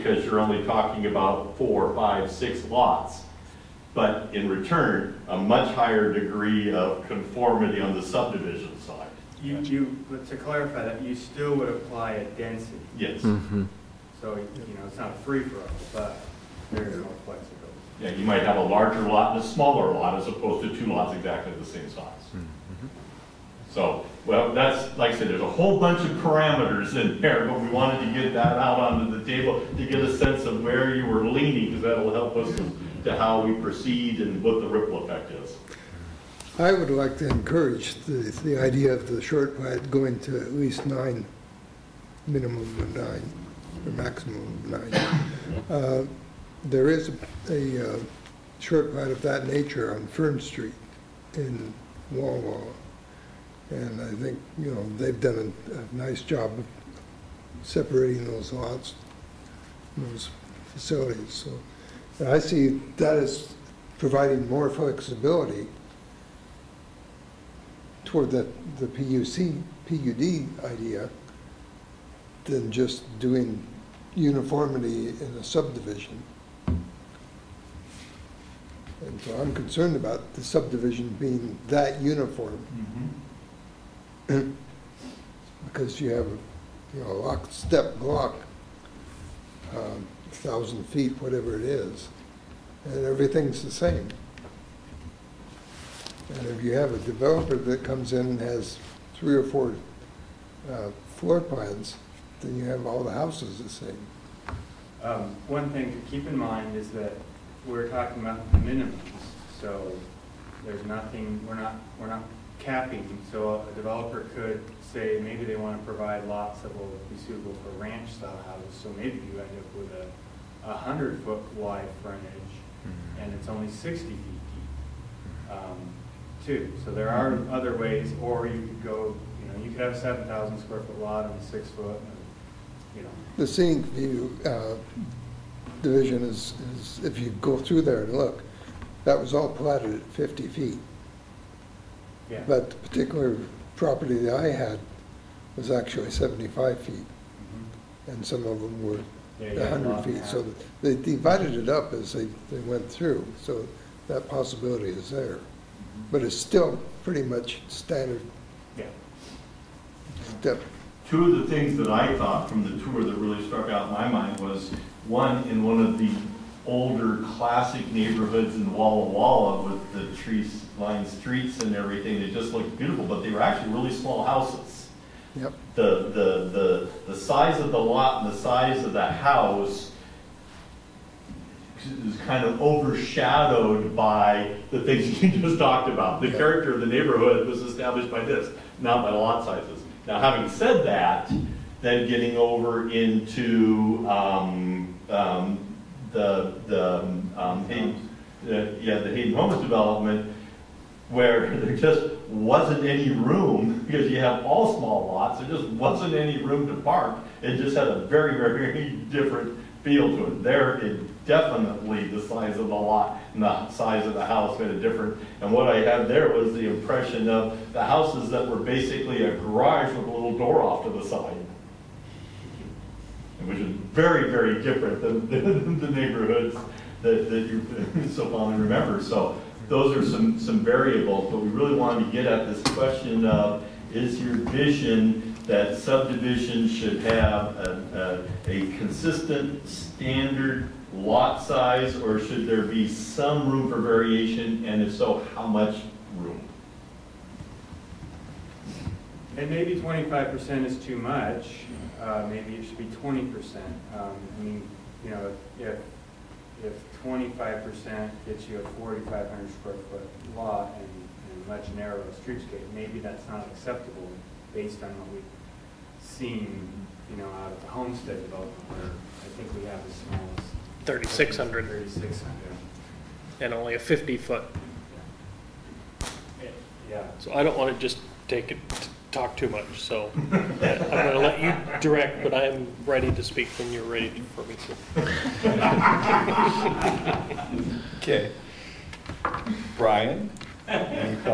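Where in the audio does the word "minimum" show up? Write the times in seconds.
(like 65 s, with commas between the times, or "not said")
42 s, 108 s.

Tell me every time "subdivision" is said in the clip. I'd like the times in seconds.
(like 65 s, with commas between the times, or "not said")
8 s, 75 s, 80 s, 235 s.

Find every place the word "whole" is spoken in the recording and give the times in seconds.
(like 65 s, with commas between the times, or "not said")
25 s.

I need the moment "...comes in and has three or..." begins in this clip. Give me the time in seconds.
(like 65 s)
97 s.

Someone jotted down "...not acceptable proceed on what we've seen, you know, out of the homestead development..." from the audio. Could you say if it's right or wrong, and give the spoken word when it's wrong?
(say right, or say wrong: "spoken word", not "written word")
wrong: "based", not "proceed".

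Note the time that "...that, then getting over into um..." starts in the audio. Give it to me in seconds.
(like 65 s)
190 s.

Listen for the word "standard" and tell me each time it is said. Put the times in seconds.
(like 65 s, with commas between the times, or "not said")
157 s, 239 s.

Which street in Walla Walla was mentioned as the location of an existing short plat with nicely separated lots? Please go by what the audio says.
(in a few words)
Fern Street.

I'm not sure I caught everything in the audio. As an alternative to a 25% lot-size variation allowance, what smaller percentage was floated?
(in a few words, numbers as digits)
20%.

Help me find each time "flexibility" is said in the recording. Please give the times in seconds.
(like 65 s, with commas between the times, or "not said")
17 s, 64 s.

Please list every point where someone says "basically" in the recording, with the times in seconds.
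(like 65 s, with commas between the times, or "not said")
218 s.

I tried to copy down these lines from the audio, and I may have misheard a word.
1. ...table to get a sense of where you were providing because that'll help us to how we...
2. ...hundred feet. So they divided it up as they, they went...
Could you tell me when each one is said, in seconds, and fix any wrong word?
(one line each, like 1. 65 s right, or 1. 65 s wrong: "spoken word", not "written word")
1. 29 s wrong: "leaning", not "providing"
2. 149 s right.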